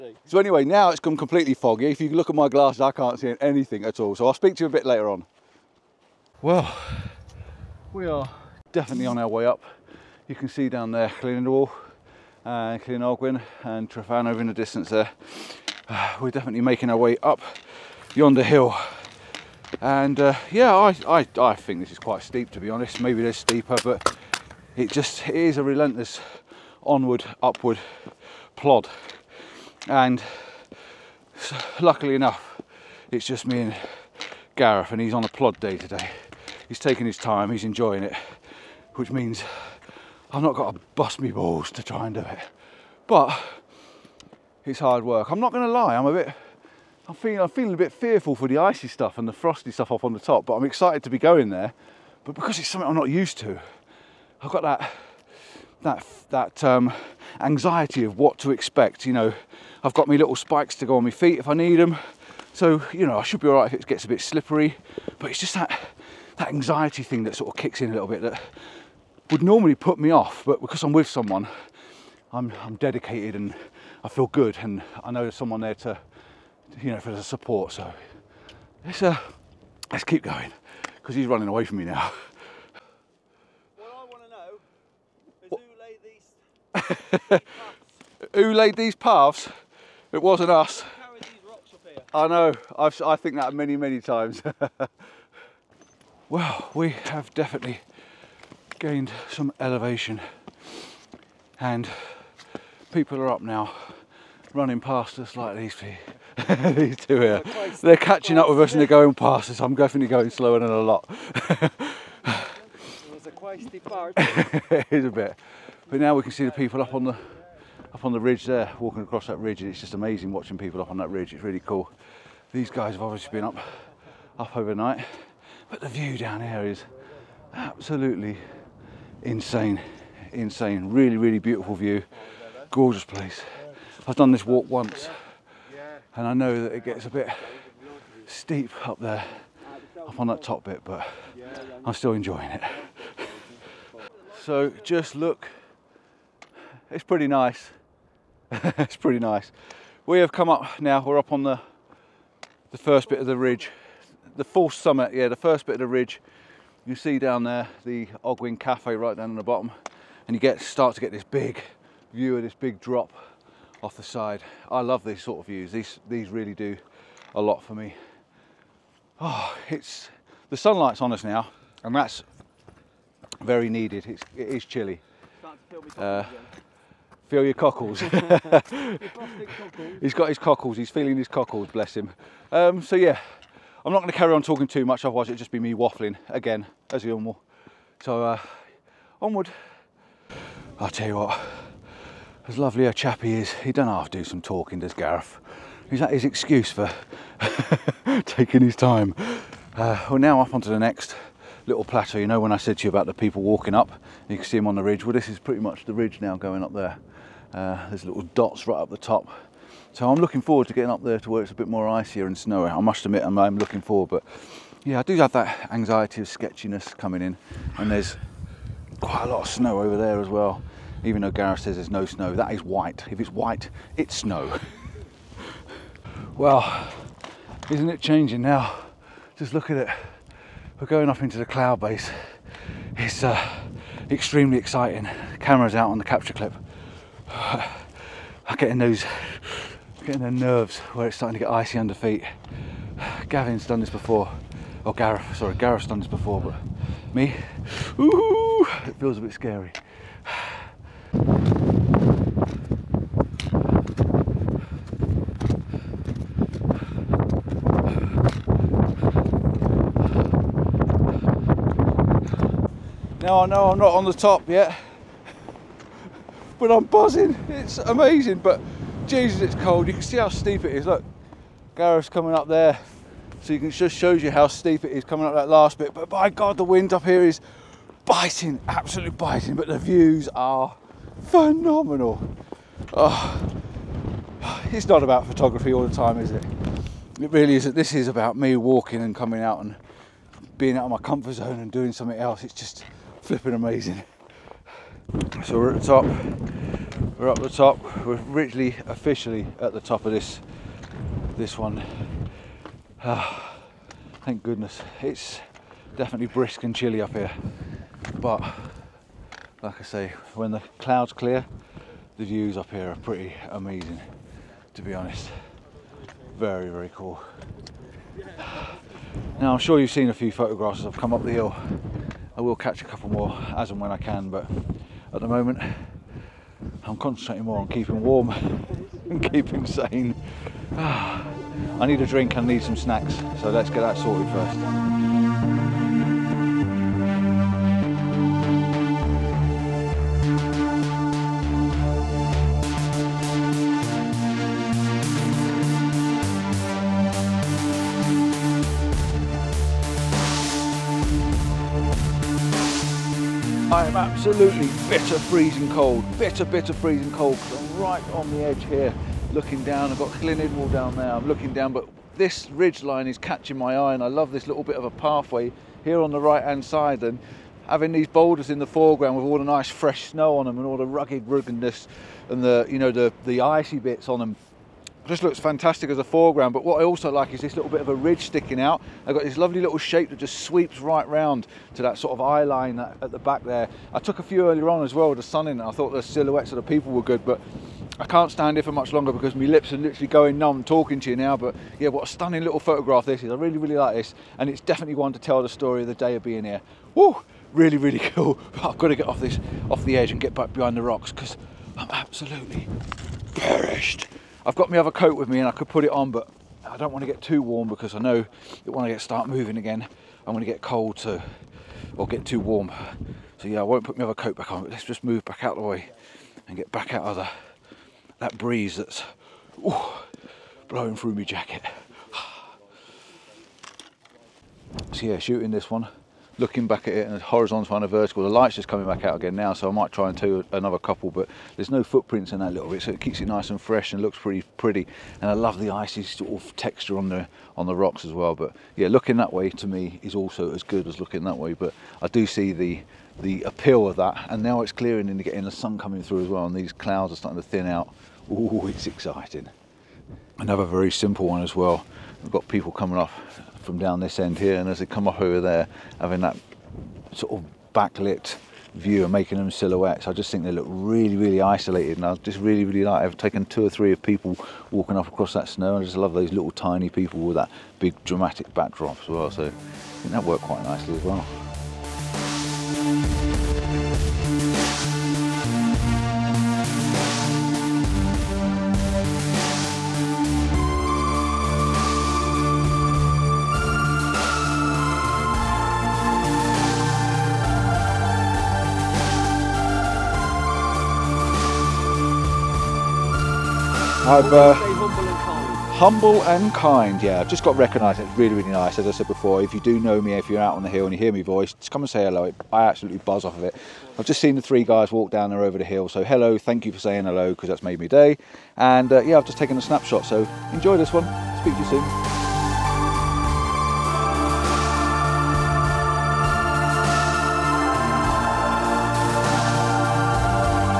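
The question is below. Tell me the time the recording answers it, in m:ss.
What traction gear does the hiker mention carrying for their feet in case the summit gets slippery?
1:00.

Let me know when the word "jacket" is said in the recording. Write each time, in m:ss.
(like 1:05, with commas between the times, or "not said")
7:01.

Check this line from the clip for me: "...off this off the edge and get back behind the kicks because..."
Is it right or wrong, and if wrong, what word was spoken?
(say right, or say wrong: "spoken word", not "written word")
wrong: "rocks", not "kicks".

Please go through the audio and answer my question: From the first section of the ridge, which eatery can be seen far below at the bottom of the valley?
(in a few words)
Ogwen Cafe.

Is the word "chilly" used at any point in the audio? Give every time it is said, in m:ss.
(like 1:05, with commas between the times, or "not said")
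2:54, 5:06.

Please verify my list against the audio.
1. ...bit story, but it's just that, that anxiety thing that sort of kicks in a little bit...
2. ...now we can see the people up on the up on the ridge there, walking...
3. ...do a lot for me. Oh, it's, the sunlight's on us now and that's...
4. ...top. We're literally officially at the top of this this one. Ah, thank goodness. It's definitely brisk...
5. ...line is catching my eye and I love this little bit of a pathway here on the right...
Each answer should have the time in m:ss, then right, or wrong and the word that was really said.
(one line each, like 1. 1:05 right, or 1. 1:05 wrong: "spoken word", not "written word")
1. 1:04 wrong: "slippery", not "story"
2. 1:55 right
3. 2:46 right
4. 4:57 right
5. 6:02 right.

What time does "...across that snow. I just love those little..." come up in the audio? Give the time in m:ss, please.
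7:45.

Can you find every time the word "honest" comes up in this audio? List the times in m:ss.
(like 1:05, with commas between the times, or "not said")
0:22, 5:14.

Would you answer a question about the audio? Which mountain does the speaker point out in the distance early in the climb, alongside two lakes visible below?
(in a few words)
Tryfan.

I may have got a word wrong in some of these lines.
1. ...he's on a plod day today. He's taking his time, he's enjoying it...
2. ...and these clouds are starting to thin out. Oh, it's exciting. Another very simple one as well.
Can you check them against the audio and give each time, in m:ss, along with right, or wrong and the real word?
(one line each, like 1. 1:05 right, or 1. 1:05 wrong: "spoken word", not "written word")
1. 0:34 right
2. 7:26 right.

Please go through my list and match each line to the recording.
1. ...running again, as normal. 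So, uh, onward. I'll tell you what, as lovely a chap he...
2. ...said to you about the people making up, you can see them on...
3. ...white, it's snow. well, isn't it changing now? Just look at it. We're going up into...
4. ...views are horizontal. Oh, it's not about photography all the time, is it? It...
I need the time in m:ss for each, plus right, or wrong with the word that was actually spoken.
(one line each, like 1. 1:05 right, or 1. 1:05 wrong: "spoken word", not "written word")
1. 3:05 wrong: "waffling", not "running"
2. 3:22 wrong: "walking", not "making"
3. 3:43 right
4. 4:39 wrong: "phenomenal", not "horizontal".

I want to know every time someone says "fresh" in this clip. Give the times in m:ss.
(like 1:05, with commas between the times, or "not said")
6:09, 7:13.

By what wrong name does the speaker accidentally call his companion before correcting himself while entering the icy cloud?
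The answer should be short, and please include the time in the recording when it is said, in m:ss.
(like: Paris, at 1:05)
Gavin, at 4:03.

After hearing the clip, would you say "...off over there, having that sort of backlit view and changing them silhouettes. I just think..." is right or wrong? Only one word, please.
wrong.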